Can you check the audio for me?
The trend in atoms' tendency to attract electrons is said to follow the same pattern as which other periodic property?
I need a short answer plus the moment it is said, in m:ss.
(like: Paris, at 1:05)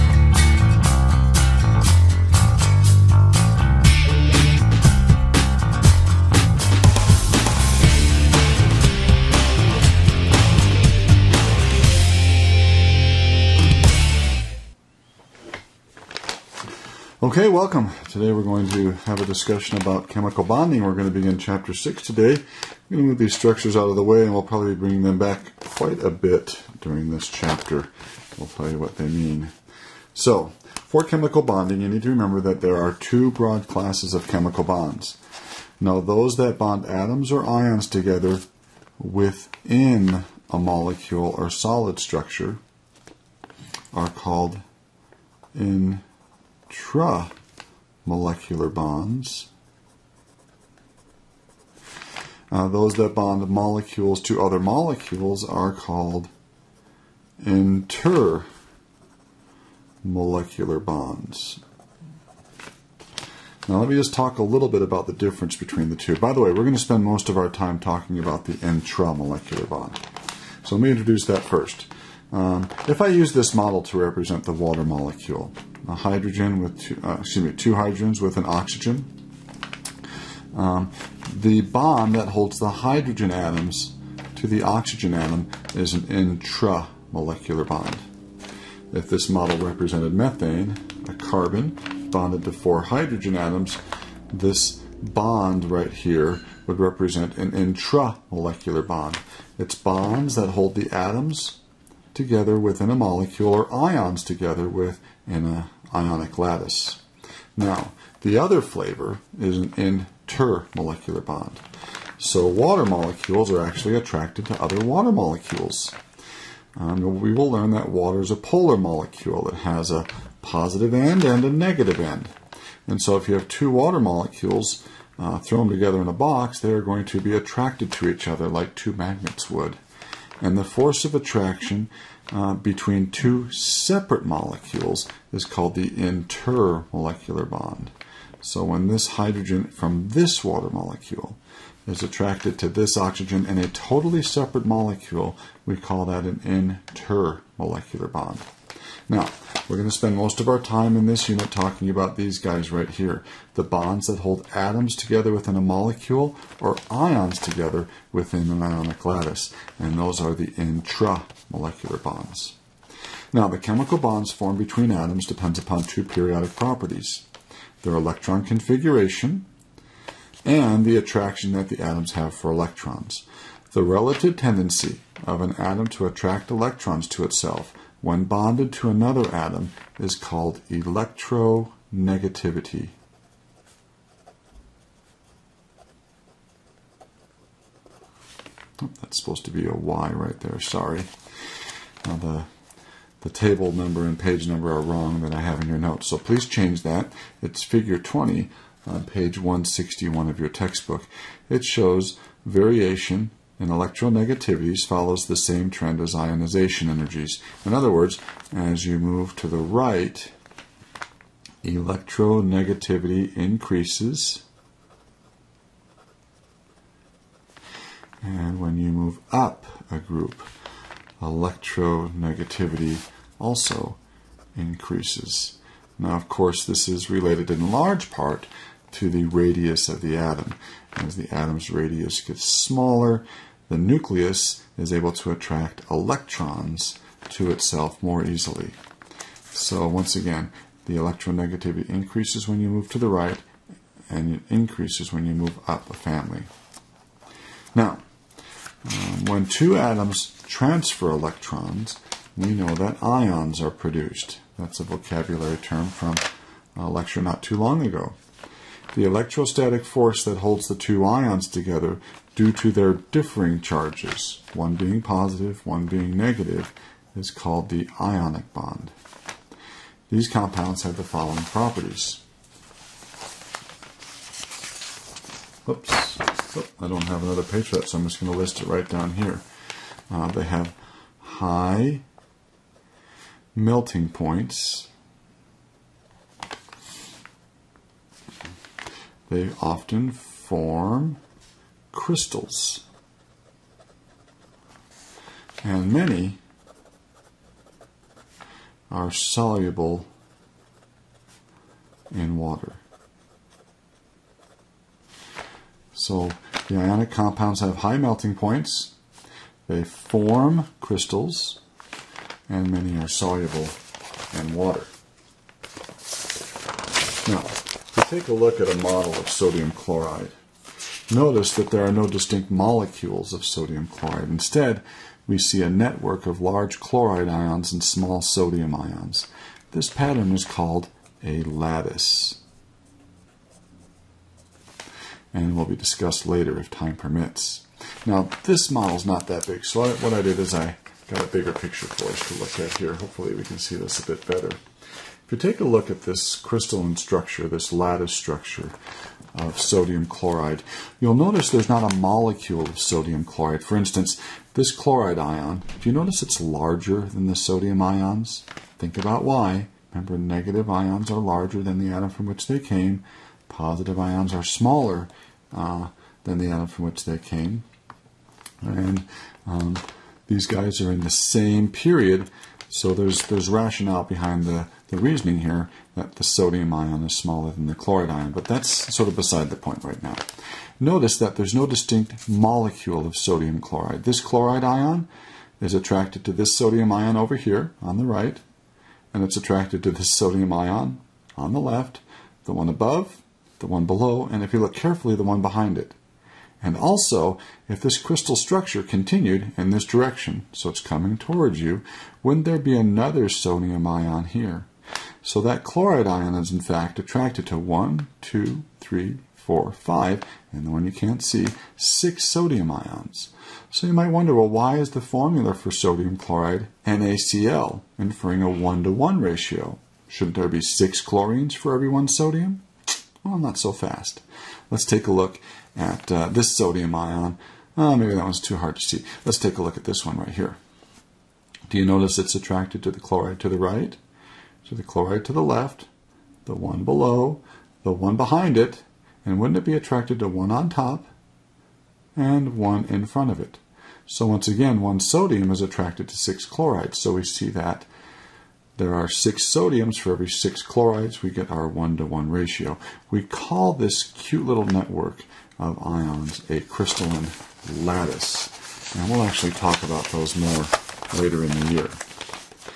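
ionization energies, at 3:26.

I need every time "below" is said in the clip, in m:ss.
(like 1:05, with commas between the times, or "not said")
6:33, 7:16.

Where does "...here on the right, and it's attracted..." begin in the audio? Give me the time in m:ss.
6:27.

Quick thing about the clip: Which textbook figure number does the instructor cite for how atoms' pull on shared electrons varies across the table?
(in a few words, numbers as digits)
20.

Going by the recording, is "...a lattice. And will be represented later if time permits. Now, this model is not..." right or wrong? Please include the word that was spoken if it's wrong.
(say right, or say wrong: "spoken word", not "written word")
wrong: "discussed", not "represented".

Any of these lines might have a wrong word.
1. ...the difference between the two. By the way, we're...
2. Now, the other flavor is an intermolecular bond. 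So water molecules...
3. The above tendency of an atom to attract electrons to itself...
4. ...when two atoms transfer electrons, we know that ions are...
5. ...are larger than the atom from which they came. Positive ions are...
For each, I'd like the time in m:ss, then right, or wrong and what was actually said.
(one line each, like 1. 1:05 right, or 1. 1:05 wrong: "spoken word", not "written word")
1. 1:05 right
2. 1:47 right
3. 2:53 wrong: "relative", not "above"
4. 4:09 right
5. 6:01 right.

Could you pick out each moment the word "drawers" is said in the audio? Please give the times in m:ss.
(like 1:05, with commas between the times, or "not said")
not said.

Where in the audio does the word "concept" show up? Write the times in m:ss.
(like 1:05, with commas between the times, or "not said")
not said.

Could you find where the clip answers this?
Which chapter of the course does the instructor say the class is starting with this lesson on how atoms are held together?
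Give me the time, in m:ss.
0:21.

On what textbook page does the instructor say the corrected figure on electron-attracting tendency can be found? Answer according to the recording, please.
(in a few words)
161.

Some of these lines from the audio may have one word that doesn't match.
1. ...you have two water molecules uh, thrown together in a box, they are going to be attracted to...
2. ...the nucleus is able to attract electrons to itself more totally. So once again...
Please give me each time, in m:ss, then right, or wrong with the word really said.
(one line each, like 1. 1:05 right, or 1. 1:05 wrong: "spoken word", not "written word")
1. 2:03 right
2. 3:53 wrong: "easily", not "totally".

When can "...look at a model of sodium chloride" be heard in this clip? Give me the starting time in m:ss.
5:18.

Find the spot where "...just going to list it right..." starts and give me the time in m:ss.
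4:38.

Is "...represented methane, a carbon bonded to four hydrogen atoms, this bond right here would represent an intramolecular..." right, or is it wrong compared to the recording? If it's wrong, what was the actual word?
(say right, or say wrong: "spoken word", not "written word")
right.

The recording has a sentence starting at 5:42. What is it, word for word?
Hopefully we can see this a bit better.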